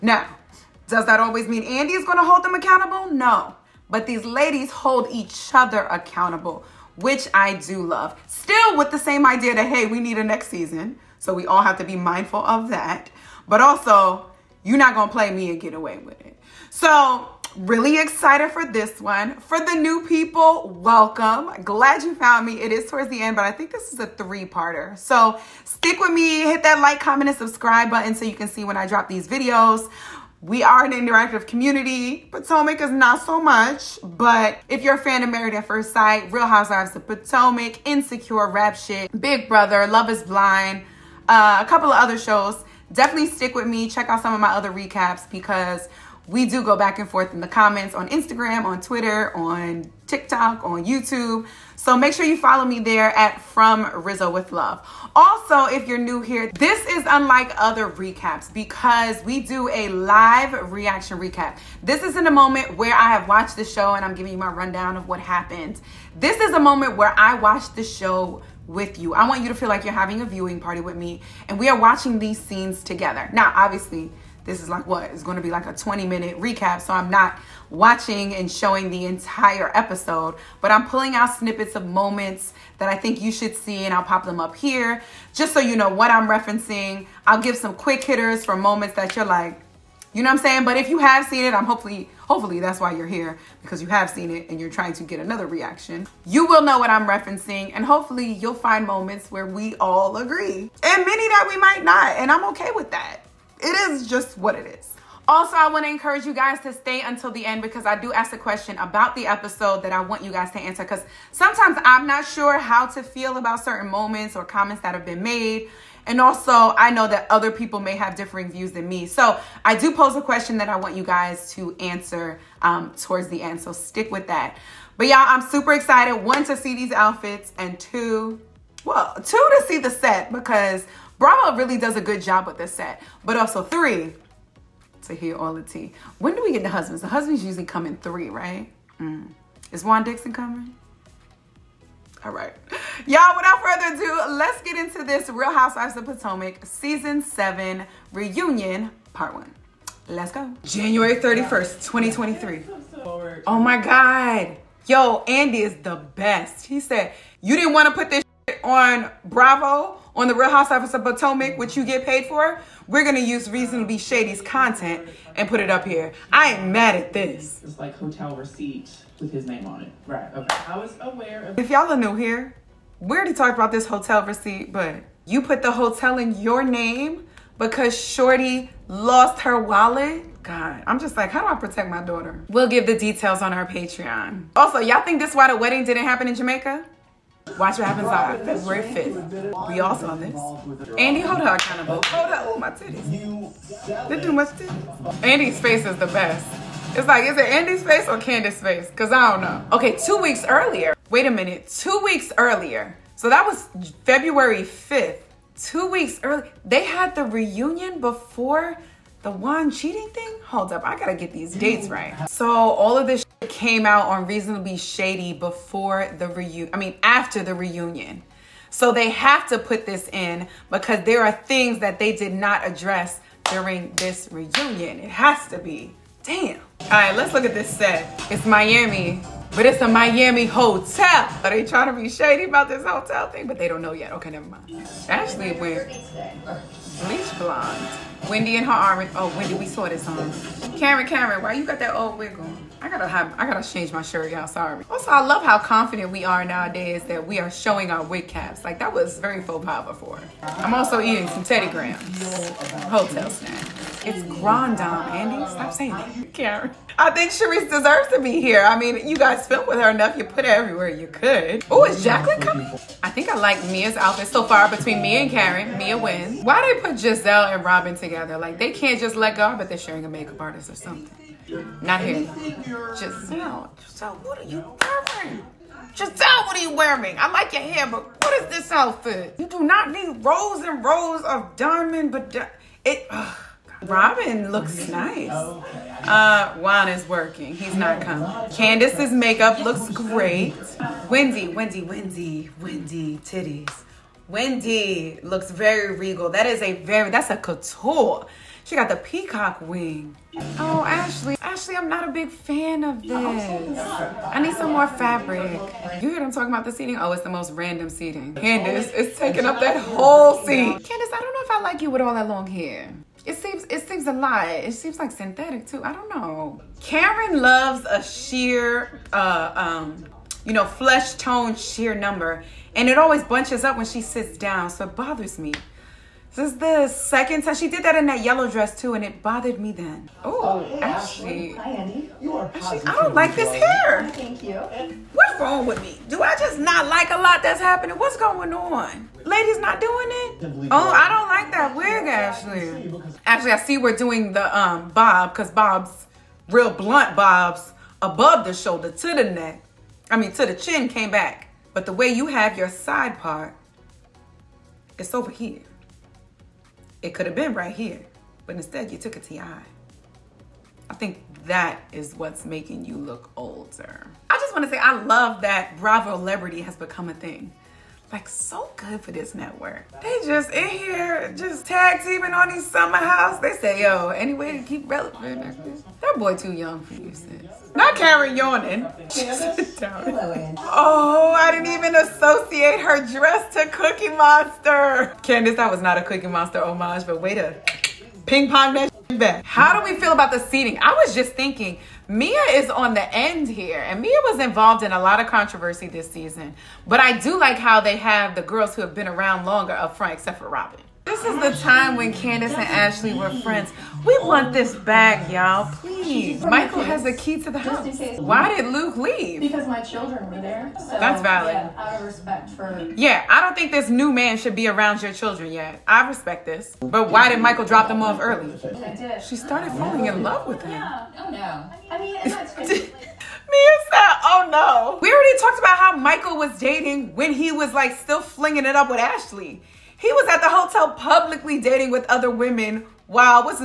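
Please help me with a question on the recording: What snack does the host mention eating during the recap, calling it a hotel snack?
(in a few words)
Teddy Grahams.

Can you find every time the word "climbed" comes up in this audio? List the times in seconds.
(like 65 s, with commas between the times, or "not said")
not said.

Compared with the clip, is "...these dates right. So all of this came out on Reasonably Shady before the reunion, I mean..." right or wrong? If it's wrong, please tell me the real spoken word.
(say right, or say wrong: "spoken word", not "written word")
right.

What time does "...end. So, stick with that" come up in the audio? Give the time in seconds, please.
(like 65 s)
123 s.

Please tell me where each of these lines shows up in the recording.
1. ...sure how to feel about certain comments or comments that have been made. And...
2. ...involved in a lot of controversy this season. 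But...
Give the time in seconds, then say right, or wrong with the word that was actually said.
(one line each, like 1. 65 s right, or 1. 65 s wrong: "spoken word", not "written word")
1. 112 s wrong: "moments", not "comments"
2. 394 s right.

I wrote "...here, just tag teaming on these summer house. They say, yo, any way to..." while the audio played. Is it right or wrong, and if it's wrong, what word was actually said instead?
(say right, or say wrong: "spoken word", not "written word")
right.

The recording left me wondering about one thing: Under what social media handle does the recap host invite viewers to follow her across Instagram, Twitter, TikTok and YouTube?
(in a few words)
From Rizzo with Love.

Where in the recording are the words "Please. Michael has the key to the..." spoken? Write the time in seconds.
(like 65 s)
405 s.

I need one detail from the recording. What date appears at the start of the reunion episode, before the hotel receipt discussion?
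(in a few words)
January 31st, 2023.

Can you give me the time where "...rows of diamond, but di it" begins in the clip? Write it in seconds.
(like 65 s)
280 s.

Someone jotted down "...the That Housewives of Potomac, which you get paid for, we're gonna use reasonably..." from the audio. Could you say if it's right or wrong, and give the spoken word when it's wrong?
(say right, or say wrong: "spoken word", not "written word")
wrong: "Real", not "That".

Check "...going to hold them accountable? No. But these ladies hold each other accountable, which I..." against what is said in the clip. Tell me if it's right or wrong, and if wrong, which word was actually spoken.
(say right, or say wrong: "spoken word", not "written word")
right.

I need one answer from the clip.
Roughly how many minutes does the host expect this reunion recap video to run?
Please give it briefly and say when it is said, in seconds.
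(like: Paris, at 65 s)
20, at 75 s.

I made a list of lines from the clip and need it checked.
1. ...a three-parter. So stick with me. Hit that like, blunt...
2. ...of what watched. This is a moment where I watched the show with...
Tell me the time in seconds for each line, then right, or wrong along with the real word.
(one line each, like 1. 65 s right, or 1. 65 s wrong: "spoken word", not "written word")
1. 24 s wrong: "comment", not "blunt"
2. 64 s wrong: "happened", not "watched".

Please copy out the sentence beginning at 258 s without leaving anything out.
I mean, you guys filmed with her enough.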